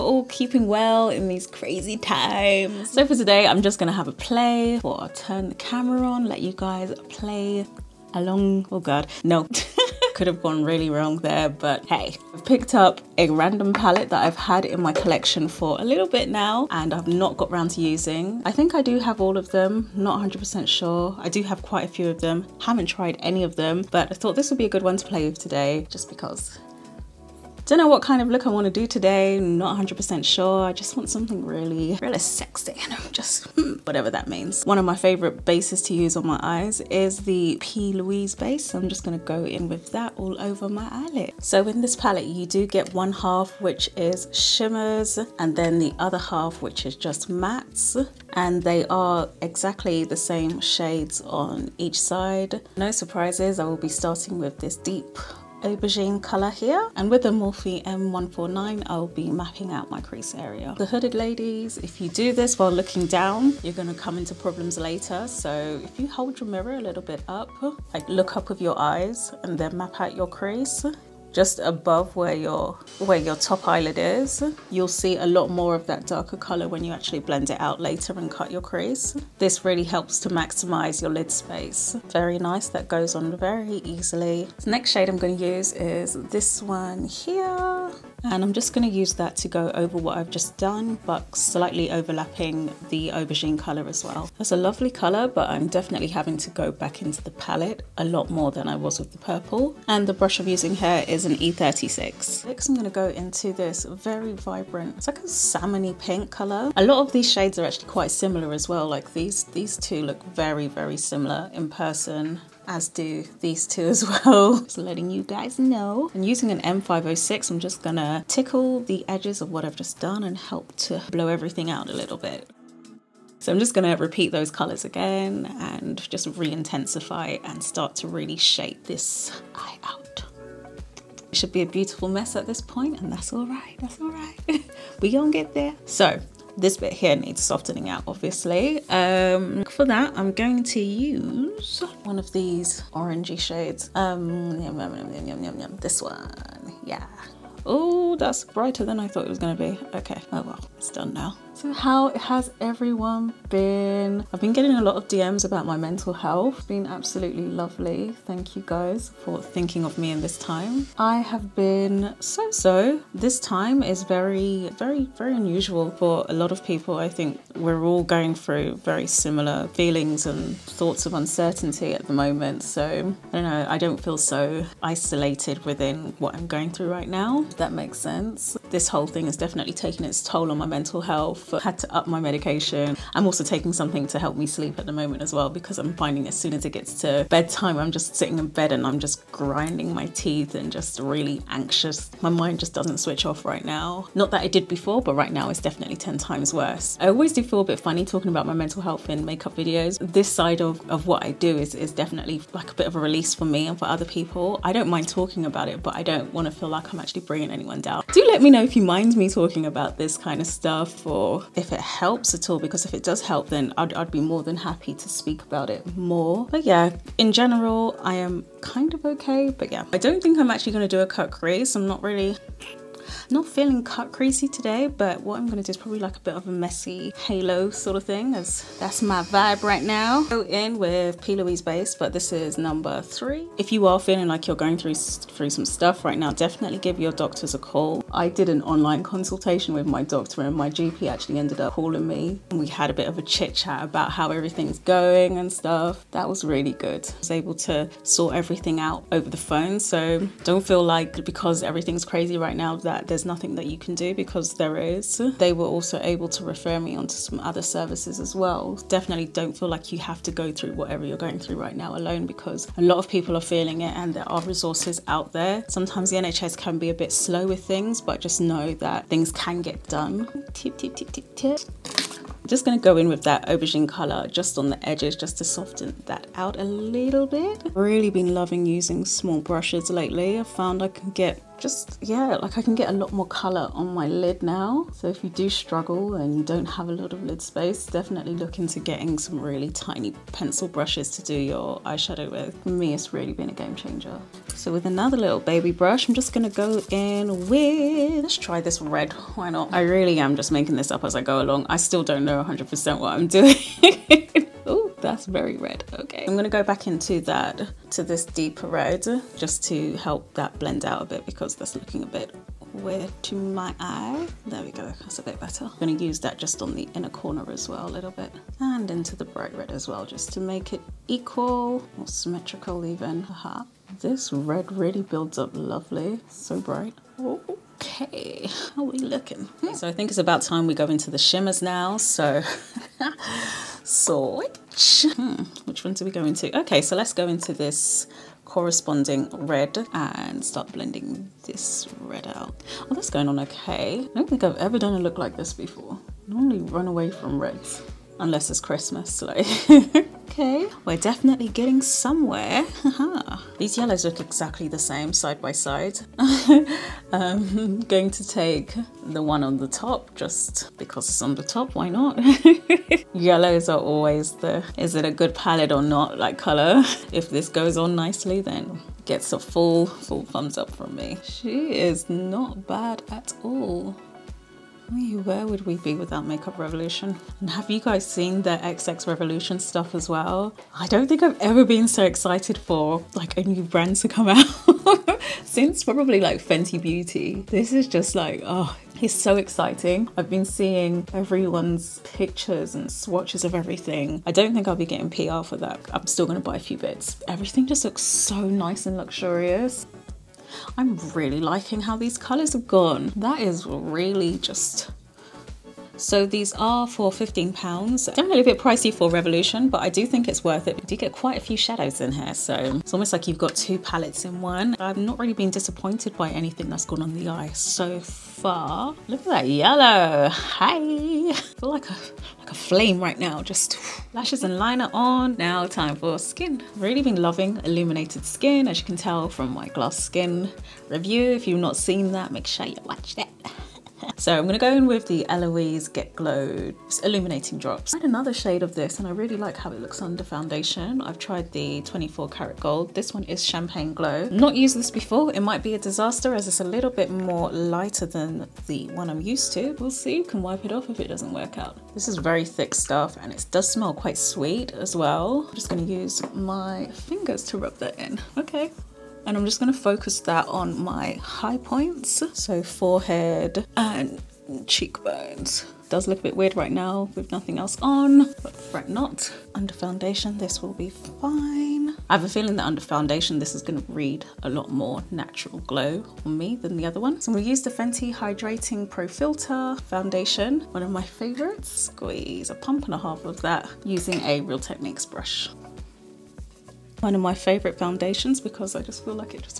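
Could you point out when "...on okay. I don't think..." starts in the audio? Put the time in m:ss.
5:43.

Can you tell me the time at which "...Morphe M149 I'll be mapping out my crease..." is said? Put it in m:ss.
0:57.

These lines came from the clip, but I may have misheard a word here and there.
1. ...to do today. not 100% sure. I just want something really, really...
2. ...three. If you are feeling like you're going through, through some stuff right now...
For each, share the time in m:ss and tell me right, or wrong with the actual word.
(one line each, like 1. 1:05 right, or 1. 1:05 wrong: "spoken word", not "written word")
1. 0:28 right
2. 3:53 right.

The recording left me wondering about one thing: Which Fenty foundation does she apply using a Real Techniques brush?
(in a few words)
Hydrating Pro Filter Foundation.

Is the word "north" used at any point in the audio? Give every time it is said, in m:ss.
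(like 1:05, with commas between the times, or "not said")
not said.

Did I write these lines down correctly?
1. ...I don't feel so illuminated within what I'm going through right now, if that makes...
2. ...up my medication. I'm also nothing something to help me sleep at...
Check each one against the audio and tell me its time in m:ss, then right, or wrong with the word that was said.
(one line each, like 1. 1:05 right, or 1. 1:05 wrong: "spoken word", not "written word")
1. 2:53 wrong: "isolated", not "illuminated"
2. 3:01 wrong: "taking", not "nothing".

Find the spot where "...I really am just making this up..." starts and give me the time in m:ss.
4:59.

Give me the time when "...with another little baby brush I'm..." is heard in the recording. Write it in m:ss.
4:54.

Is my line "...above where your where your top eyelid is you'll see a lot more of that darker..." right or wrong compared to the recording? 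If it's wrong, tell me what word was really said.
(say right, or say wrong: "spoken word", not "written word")
right.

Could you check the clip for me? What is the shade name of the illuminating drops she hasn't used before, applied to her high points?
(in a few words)
Champagne Glow.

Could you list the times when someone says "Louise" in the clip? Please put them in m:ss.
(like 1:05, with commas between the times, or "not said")
0:37, 3:51.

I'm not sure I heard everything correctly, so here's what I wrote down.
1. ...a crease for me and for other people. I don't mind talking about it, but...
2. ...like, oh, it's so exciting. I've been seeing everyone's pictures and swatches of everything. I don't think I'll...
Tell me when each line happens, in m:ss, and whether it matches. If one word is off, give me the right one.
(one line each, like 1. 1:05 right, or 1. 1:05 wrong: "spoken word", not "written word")
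1. 3:22 wrong: "release", not "crease"
2. 6:28 right.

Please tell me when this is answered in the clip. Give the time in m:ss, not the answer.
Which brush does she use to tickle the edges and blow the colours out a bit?
1:56.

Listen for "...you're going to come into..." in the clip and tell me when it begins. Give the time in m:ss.
1:03.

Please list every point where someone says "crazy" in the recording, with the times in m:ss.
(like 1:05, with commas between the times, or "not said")
0:01, 3:44, 4:12.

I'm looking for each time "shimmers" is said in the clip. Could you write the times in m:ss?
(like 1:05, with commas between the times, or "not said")
0:44, 5:31.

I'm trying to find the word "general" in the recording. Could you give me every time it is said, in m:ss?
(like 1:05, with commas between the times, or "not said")
3:37.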